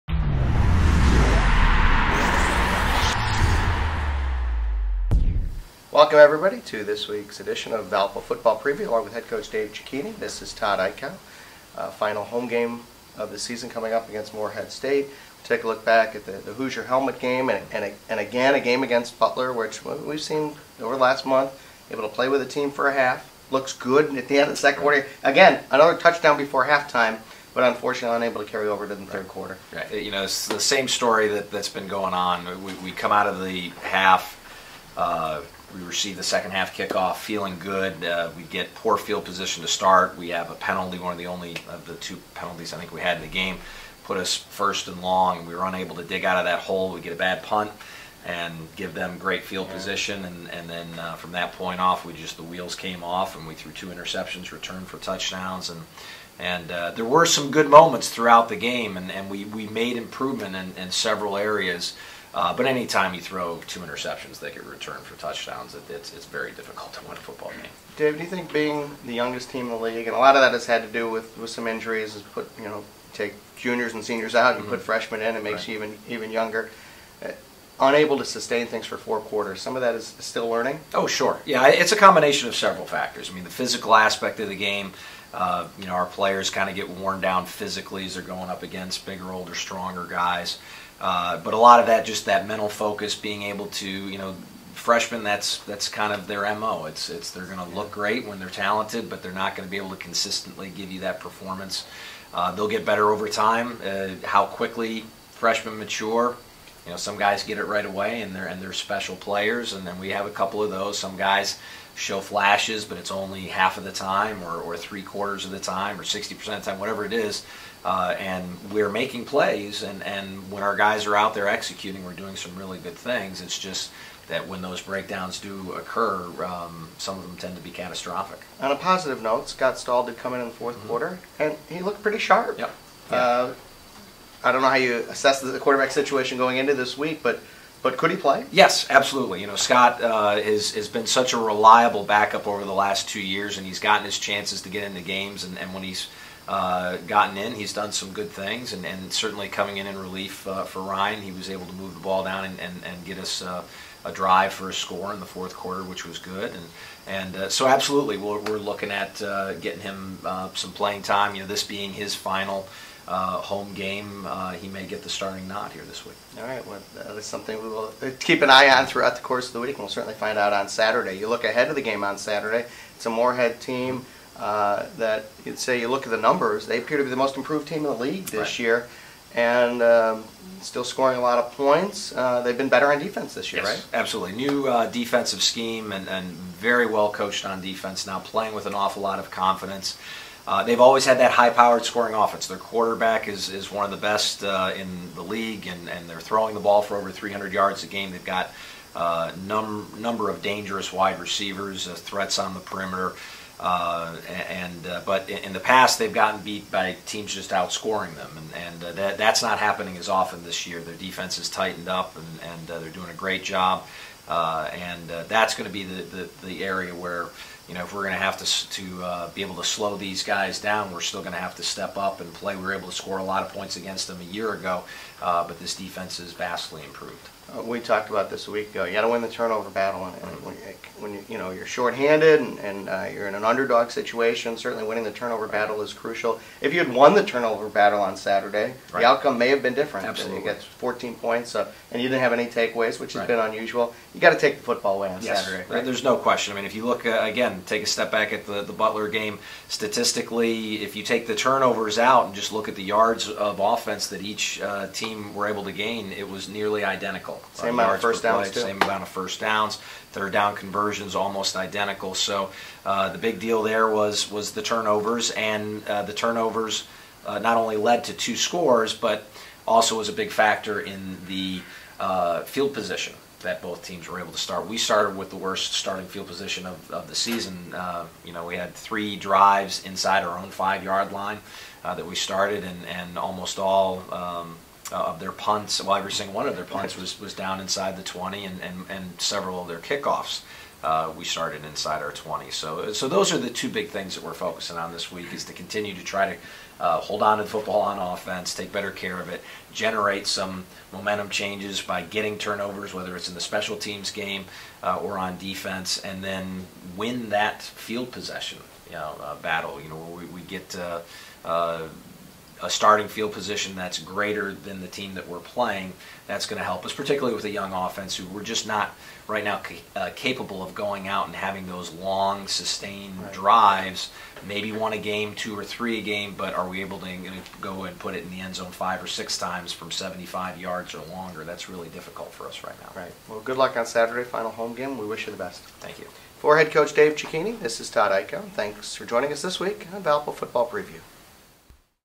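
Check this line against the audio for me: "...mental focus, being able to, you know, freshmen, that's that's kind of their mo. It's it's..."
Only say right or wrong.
right.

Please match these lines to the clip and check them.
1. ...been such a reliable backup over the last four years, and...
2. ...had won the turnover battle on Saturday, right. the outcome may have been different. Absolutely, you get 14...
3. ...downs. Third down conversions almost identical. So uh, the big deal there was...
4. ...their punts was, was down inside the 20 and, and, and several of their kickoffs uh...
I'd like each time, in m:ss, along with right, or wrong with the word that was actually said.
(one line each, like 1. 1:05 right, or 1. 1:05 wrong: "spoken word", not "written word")
1. 2:20 wrong: "two", not "four"
2. 3:56 right
3. 4:19 right
4. 4:46 right.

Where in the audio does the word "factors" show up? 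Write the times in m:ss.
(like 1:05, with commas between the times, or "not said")
1:22, 4:30.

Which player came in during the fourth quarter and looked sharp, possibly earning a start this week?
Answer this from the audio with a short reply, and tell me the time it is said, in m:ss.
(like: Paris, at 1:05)
Scott Stahl, at 2:09.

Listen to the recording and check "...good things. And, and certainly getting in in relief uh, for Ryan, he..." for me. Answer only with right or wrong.
wrong.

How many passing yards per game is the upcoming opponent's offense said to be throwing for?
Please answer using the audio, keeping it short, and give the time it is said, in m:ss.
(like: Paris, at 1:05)
over 300, at 3:16.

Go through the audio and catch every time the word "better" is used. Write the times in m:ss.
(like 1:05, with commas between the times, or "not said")
1:42, 3:02, 4:58.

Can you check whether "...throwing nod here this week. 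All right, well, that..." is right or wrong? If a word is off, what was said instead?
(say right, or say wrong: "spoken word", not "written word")
wrong: "starting", not "throwing".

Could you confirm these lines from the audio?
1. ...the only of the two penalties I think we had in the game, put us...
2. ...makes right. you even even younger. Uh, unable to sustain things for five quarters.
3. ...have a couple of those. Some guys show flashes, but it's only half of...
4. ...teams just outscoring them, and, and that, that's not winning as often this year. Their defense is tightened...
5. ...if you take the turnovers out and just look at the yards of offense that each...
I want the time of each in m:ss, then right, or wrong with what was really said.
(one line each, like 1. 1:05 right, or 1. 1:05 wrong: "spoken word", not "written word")
1. 0:41 right
2. 1:15 wrong: "four", not "five"
3. 1:50 right
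4. 3:27 wrong: "happening", not "winning"
5. 4:10 right.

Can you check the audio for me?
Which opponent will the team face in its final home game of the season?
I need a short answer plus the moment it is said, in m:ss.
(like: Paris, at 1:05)
Morehead State, at 0:14.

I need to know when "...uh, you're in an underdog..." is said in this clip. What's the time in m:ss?
3:52.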